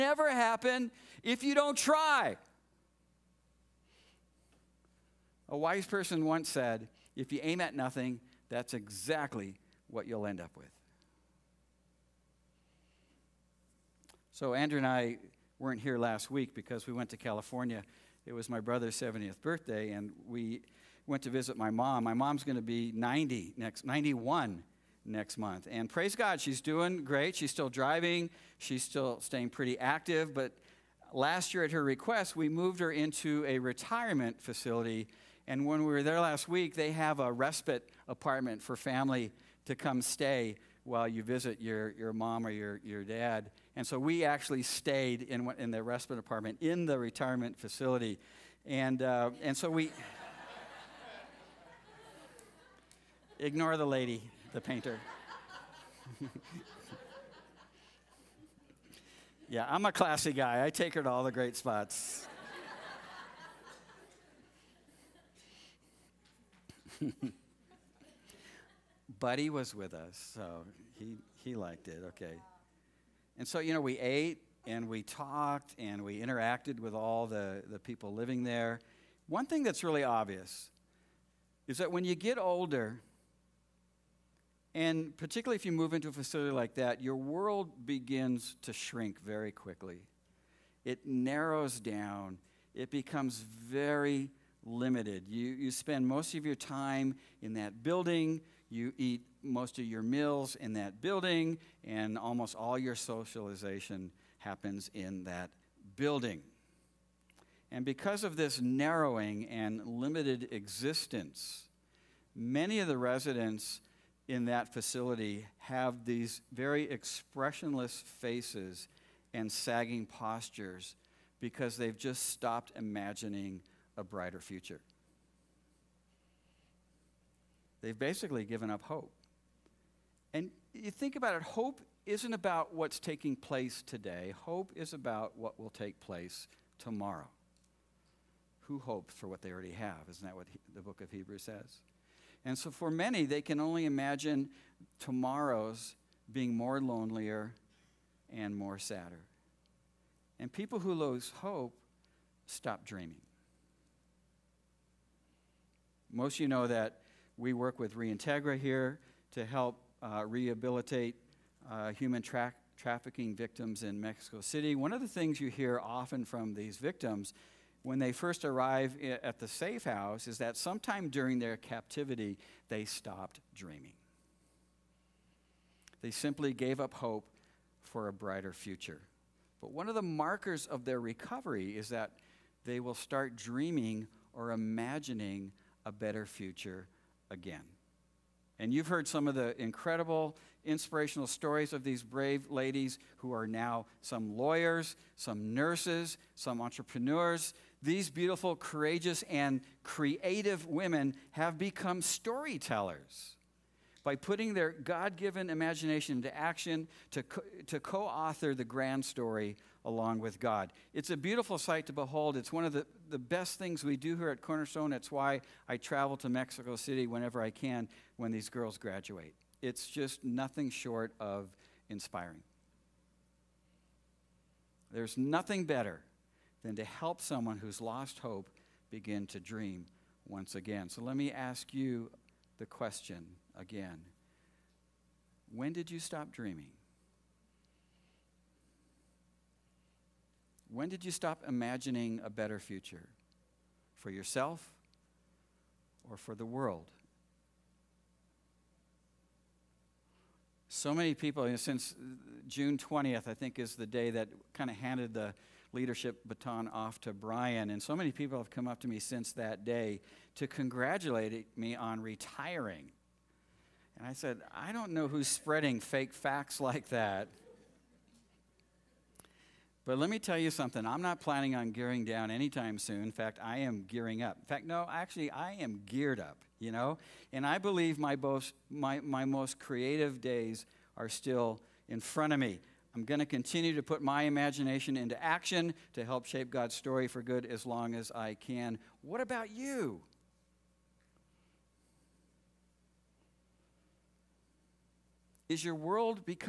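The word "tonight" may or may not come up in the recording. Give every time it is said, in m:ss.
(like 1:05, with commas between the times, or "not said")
not said.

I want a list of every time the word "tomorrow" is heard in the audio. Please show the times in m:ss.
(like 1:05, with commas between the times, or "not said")
2:16, 2:24.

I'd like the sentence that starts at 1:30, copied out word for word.
It narrows down, it becomes very limited.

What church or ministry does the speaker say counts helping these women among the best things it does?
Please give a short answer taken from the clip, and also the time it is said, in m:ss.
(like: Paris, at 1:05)
Cornerstone, at 3:34.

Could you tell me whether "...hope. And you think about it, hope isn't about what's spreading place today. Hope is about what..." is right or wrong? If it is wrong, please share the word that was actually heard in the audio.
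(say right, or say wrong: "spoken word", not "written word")
wrong: "taking", not "spreading".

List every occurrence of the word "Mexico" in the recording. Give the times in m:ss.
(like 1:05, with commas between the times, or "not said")
2:43, 3:36.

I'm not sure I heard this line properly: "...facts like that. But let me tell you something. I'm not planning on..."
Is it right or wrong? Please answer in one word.
right.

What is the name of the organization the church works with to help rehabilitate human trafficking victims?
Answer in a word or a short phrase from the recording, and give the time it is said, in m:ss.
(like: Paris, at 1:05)
Reintegra, at 2:37.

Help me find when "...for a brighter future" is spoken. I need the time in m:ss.
2:57.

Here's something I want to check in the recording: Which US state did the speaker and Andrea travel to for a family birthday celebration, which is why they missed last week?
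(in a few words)
California.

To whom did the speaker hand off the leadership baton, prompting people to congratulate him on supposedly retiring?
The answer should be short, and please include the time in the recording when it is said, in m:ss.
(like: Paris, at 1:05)
Brian, at 4:17.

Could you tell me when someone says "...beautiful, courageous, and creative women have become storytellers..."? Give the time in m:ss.
3:18.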